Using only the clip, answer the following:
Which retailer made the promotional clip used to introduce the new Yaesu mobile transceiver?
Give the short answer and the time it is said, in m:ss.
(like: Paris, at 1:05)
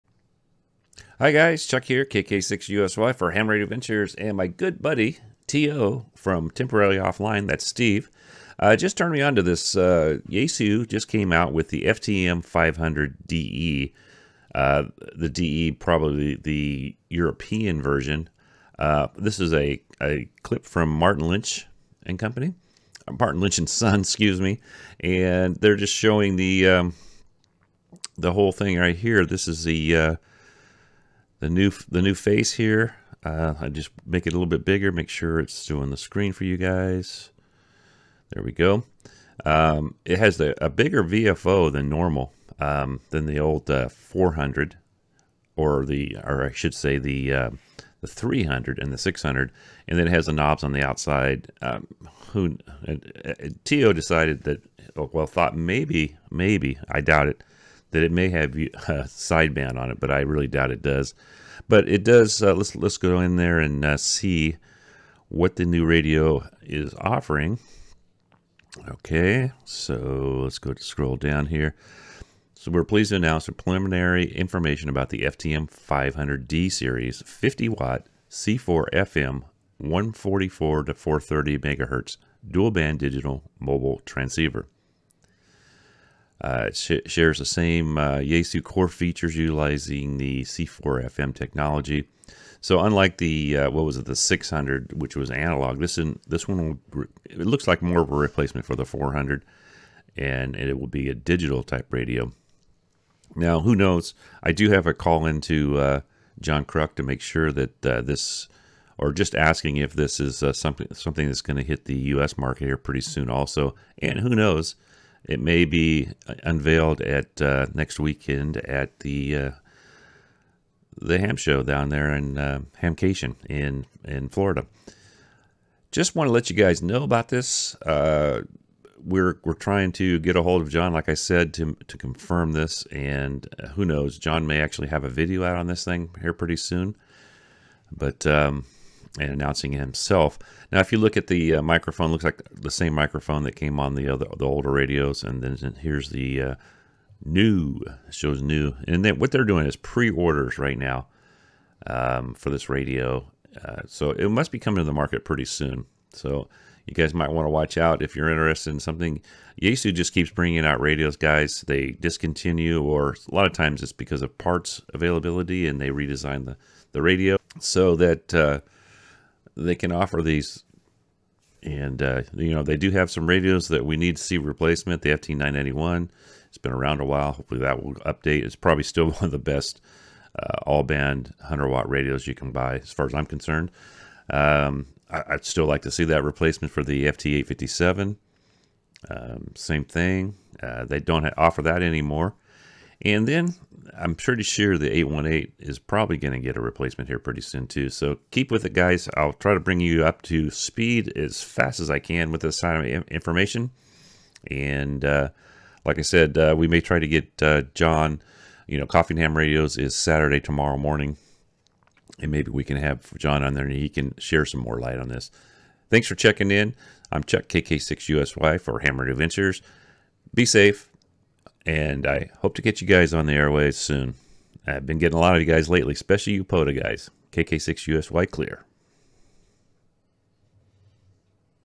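Martin Lynch and Son, at 0:23.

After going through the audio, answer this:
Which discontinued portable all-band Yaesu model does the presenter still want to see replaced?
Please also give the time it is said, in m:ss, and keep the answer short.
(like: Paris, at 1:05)
FT857, at 3:07.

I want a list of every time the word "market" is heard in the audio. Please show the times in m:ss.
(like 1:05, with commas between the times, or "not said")
1:52, 2:34.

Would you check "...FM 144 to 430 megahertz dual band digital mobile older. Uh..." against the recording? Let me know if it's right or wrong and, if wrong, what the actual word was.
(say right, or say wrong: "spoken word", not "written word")
wrong: "transceiver", not "older".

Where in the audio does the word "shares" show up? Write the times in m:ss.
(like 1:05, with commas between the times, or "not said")
1:27, 3:34.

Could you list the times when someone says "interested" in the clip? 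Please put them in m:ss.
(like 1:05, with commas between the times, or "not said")
2:38.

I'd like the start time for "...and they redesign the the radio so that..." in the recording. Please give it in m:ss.
2:45.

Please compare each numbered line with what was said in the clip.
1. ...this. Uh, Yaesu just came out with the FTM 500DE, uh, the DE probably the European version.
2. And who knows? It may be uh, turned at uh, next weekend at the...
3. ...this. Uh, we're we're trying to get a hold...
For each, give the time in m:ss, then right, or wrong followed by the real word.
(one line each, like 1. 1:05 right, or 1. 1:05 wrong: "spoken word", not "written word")
1. 0:09 right
2. 1:53 wrong: "unveiled", not "turned"
3. 2:07 right.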